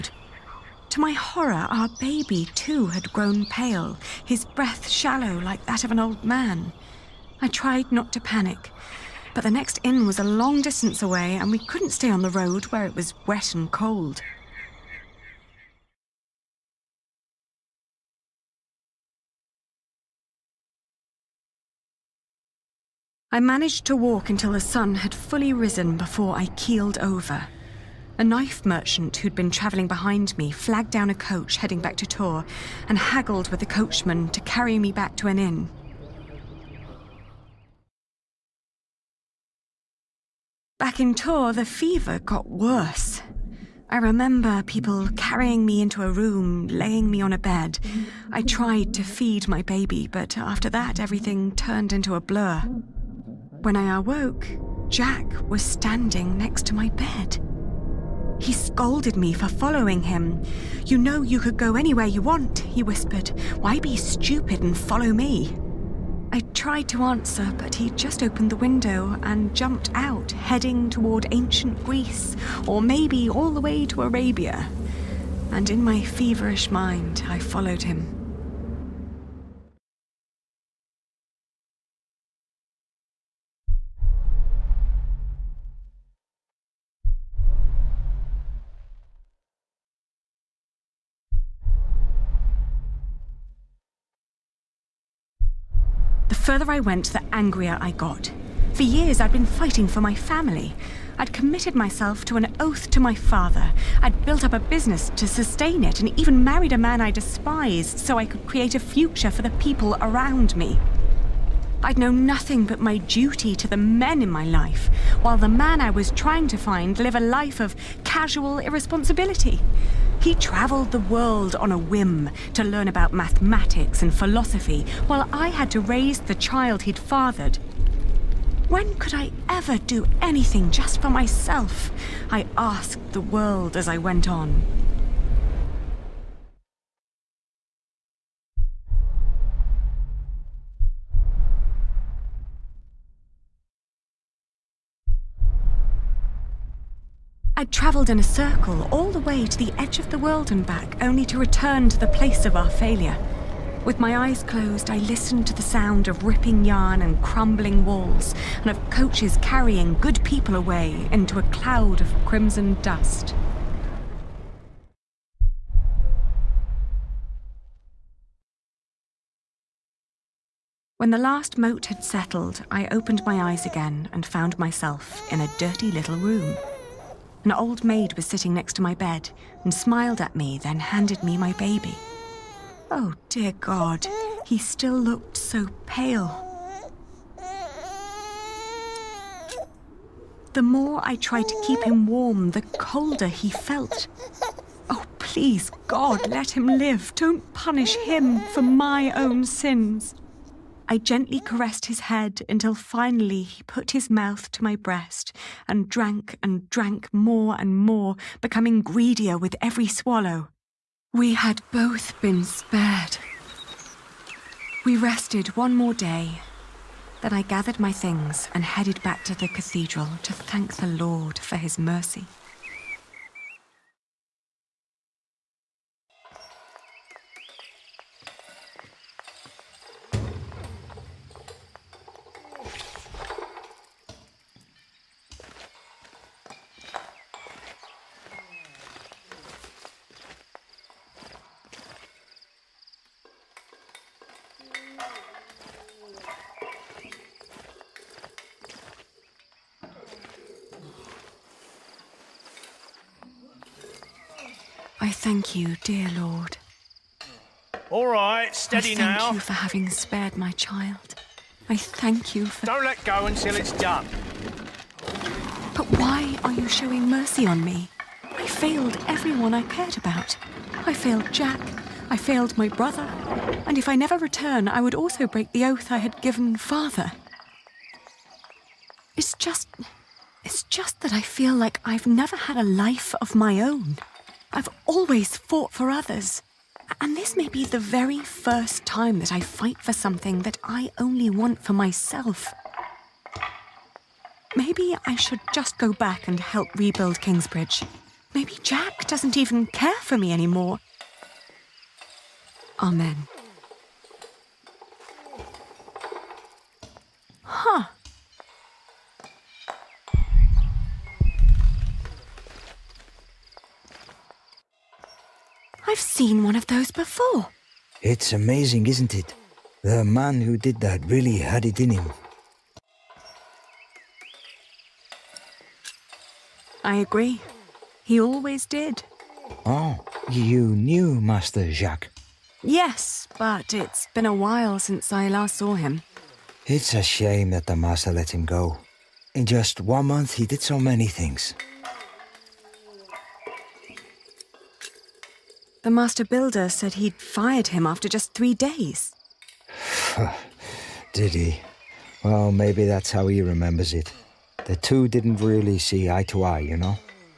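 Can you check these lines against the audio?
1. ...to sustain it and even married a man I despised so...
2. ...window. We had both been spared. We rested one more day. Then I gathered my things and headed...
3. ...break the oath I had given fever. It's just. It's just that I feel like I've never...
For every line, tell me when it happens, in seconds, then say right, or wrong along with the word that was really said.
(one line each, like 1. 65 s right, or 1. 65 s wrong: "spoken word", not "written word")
1. 105 s right
2. 209 s wrong: "swallow", not "window"
3. 275 s wrong: "father", not "fever".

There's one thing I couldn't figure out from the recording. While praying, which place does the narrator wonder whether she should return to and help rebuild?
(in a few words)
Kingsbridge.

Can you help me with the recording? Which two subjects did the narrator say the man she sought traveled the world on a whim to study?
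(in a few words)
Mathematics and philosophy.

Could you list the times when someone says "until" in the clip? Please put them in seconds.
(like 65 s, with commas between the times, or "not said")
24 s, 202 s, 263 s.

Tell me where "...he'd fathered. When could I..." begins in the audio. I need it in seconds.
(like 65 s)
126 s.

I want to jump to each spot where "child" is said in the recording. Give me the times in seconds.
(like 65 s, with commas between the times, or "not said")
126 s, 260 s.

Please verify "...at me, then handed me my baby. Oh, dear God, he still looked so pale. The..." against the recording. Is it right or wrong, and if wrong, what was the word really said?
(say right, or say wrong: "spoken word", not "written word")
right.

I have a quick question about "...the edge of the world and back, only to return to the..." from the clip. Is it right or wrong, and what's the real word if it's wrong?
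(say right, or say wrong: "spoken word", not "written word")
right.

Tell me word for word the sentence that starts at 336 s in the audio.
It's a shame that the master let him go.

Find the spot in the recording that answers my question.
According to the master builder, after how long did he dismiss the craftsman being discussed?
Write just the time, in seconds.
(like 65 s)
348 s.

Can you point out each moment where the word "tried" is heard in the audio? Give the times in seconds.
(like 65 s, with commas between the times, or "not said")
7 s, 48 s, 66 s, 191 s.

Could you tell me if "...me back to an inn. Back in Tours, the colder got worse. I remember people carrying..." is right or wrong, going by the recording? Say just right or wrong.
wrong.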